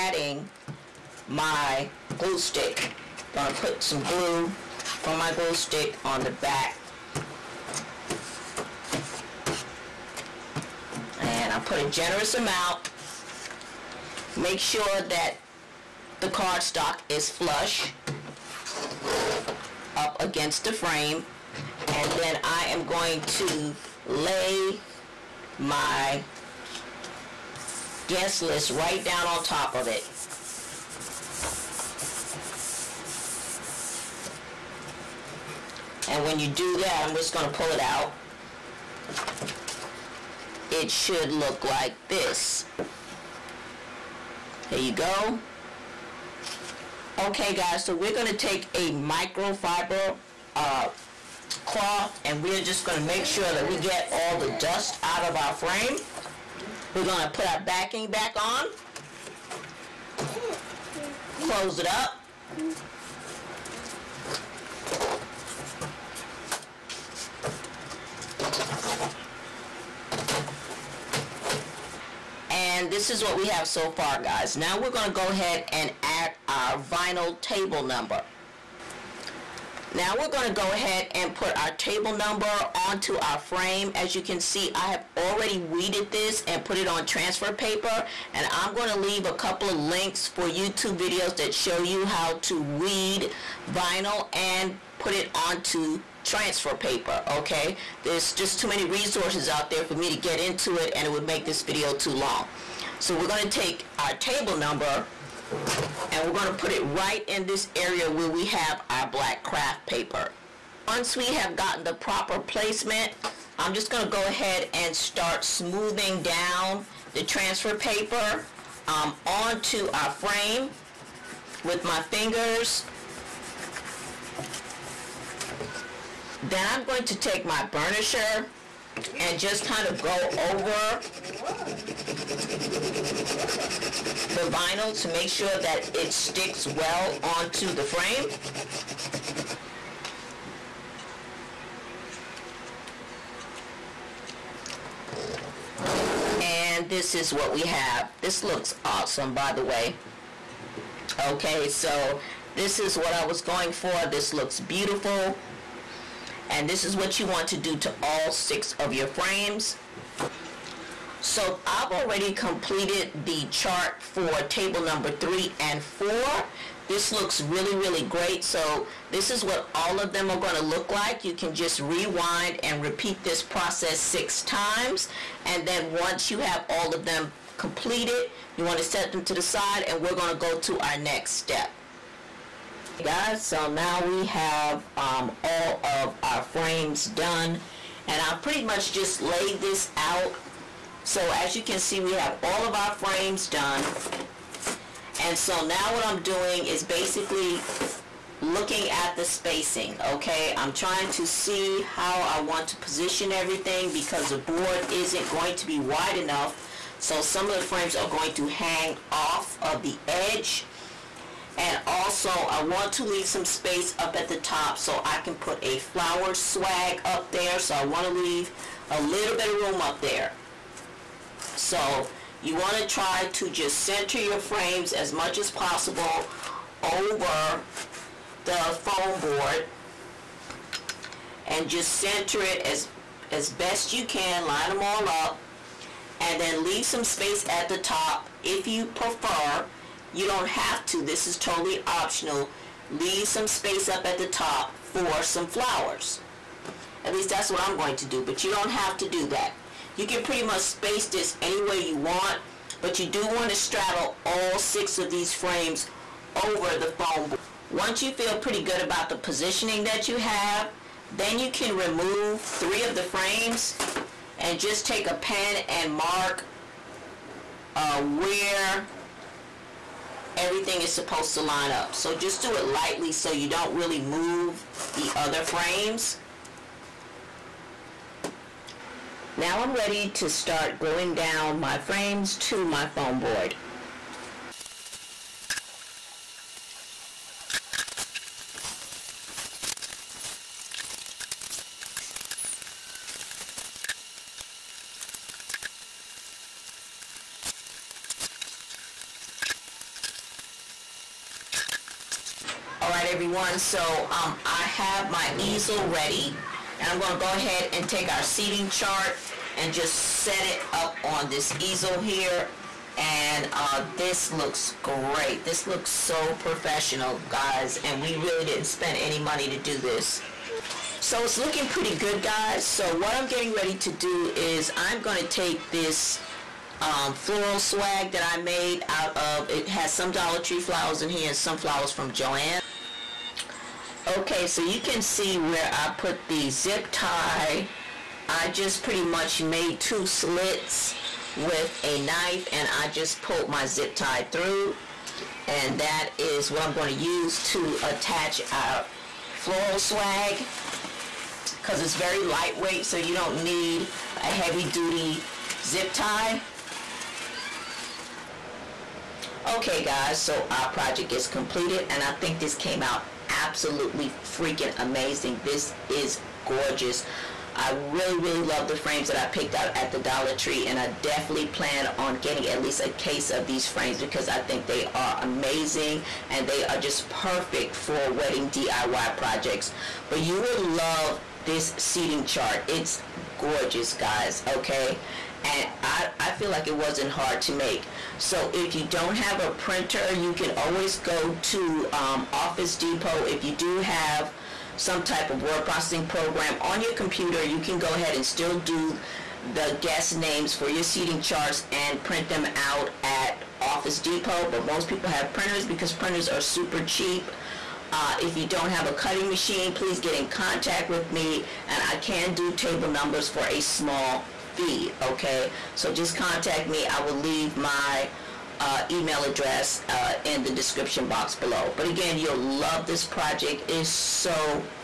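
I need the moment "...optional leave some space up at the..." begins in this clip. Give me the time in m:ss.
4:01.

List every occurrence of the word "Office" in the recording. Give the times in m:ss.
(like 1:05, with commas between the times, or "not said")
6:32, 6:43.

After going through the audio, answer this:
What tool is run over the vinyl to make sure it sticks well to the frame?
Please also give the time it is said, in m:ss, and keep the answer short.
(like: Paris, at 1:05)
burnisher, at 2:07.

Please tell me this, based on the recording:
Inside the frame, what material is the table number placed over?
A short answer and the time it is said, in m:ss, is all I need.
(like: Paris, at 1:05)
black craft paper, at 1:49.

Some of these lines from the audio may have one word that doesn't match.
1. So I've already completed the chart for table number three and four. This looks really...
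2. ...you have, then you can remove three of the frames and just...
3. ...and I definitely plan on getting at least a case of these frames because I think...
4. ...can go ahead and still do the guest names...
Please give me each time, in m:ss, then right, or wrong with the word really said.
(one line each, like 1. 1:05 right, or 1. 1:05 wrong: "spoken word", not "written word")
1. 2:41 right
2. 4:20 right
3. 6:10 right
4. 6:37 right.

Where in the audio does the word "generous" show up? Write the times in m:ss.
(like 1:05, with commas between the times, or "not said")
0:11.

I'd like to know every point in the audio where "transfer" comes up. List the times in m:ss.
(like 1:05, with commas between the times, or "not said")
1:27, 1:36, 1:57.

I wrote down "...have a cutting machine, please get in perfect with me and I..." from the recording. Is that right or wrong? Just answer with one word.
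wrong.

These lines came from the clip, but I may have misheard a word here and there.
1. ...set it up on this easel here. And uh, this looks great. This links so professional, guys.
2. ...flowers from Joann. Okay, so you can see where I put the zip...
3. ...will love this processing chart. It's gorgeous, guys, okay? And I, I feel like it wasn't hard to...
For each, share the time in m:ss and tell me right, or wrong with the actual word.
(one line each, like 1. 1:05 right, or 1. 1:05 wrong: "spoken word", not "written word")
1. 5:09 wrong: "looks", not "links"
2. 5:31 right
3. 6:20 wrong: "seating", not "processing".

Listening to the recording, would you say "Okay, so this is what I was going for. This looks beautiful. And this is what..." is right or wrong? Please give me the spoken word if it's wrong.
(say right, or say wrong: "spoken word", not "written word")
right.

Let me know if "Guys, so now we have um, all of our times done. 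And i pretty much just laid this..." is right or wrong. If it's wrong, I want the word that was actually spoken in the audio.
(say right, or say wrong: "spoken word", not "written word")
wrong: "frames", not "times".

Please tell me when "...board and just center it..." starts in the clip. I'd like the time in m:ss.
3:49.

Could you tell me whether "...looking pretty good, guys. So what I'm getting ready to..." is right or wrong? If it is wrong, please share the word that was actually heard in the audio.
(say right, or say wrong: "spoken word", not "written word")
right.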